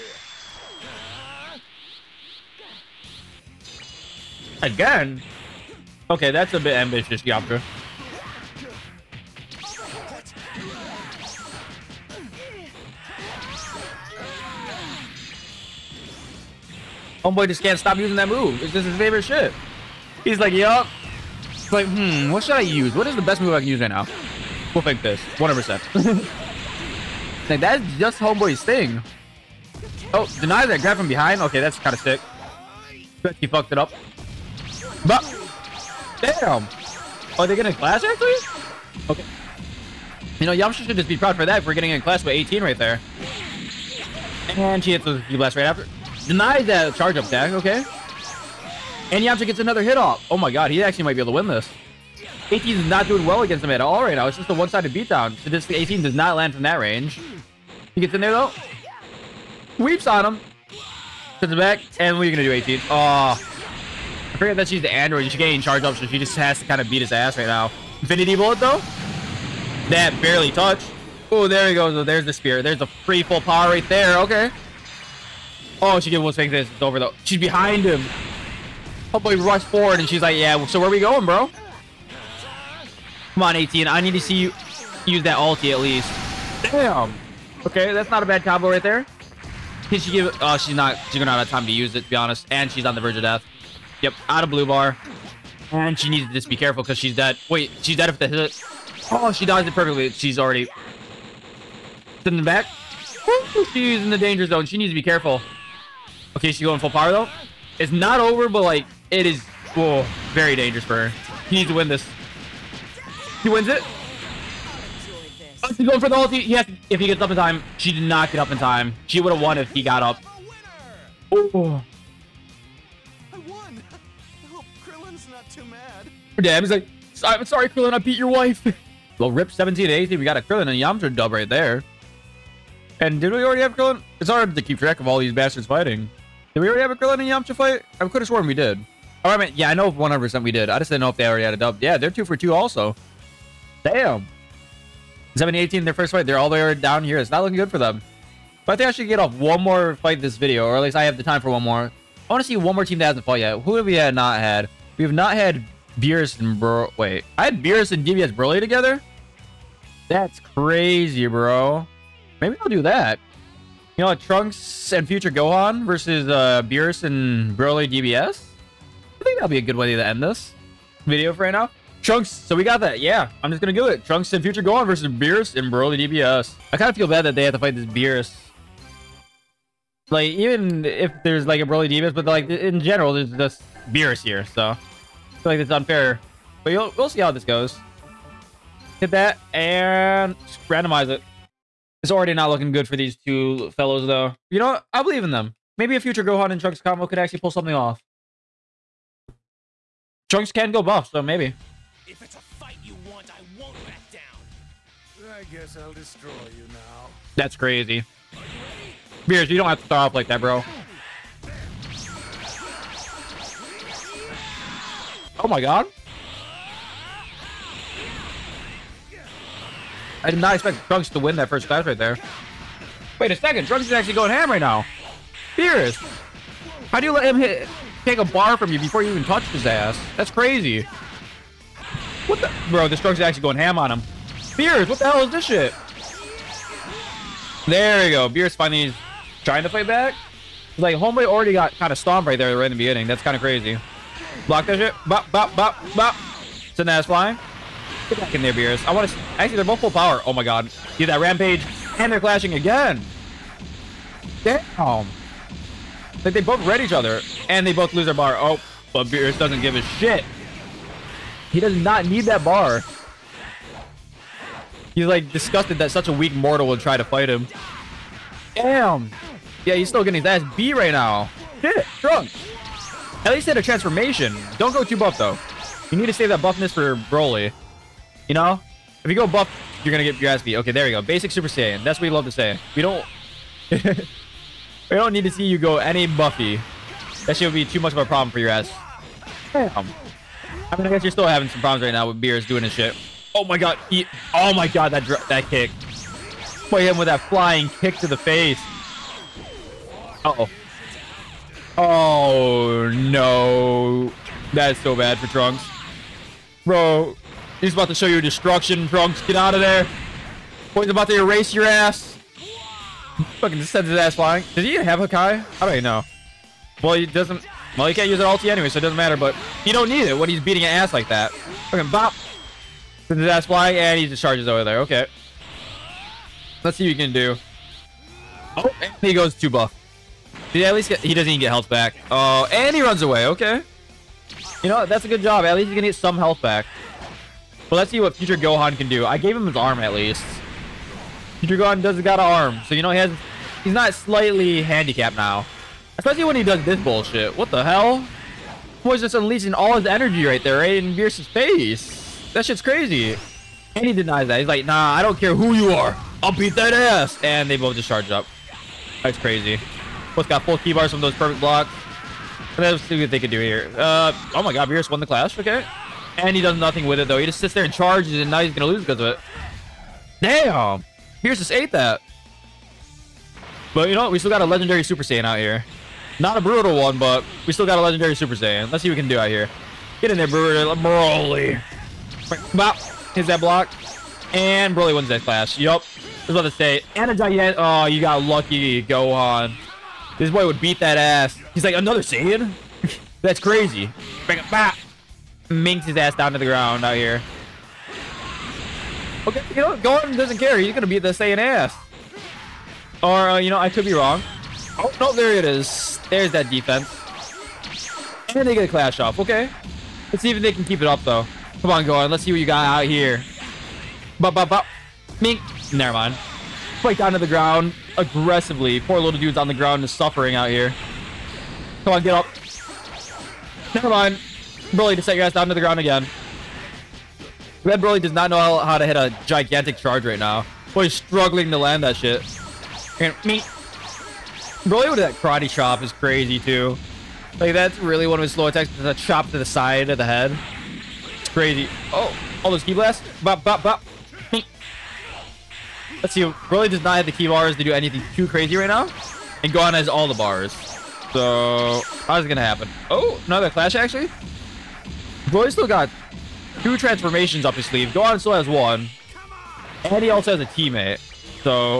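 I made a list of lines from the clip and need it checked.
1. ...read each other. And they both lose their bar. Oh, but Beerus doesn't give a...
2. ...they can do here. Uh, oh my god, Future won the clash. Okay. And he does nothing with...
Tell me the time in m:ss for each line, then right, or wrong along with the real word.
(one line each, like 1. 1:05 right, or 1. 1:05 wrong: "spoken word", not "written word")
1. 4:16 right
2. 6:03 wrong: "Beerus", not "Future".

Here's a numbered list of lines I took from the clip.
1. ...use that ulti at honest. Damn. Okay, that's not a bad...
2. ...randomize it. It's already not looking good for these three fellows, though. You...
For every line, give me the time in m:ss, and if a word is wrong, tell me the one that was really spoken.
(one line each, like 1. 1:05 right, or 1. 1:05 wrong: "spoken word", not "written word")
1. 1:25 wrong: "least", not "honest"
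2. 3:10 wrong: "two", not "three".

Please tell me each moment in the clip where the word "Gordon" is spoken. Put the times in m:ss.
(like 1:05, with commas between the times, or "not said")
6:39, 6:51.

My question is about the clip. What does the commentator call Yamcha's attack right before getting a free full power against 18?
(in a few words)
the spear.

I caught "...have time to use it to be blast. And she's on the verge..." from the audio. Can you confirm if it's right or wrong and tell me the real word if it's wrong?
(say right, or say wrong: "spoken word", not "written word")
wrong: "honest", not "blast".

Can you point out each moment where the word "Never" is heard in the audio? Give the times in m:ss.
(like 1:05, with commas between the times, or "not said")
6:55, 7:03.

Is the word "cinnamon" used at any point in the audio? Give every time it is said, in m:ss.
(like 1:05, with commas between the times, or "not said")
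not said.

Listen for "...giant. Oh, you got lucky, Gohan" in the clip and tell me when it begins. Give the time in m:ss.
6:27.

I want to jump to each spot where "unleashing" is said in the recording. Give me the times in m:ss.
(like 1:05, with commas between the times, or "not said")
5:49.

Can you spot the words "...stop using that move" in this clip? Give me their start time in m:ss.
0:17.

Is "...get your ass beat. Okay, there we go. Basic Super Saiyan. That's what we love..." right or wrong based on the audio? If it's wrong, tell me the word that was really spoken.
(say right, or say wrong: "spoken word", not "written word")
right.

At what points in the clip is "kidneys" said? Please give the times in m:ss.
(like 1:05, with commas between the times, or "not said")
not said.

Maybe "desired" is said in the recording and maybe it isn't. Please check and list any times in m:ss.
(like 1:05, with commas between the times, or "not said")
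not said.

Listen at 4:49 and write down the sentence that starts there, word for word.
Um, I mean, I guess you're still having some problems right now with Beerus doing his shit.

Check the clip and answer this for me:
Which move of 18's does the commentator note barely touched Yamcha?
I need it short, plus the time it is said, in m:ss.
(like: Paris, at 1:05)
Infinity bullet, at 1:07.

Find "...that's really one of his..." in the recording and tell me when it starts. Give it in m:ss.
7:17.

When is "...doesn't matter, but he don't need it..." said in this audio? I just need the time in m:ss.
5:18.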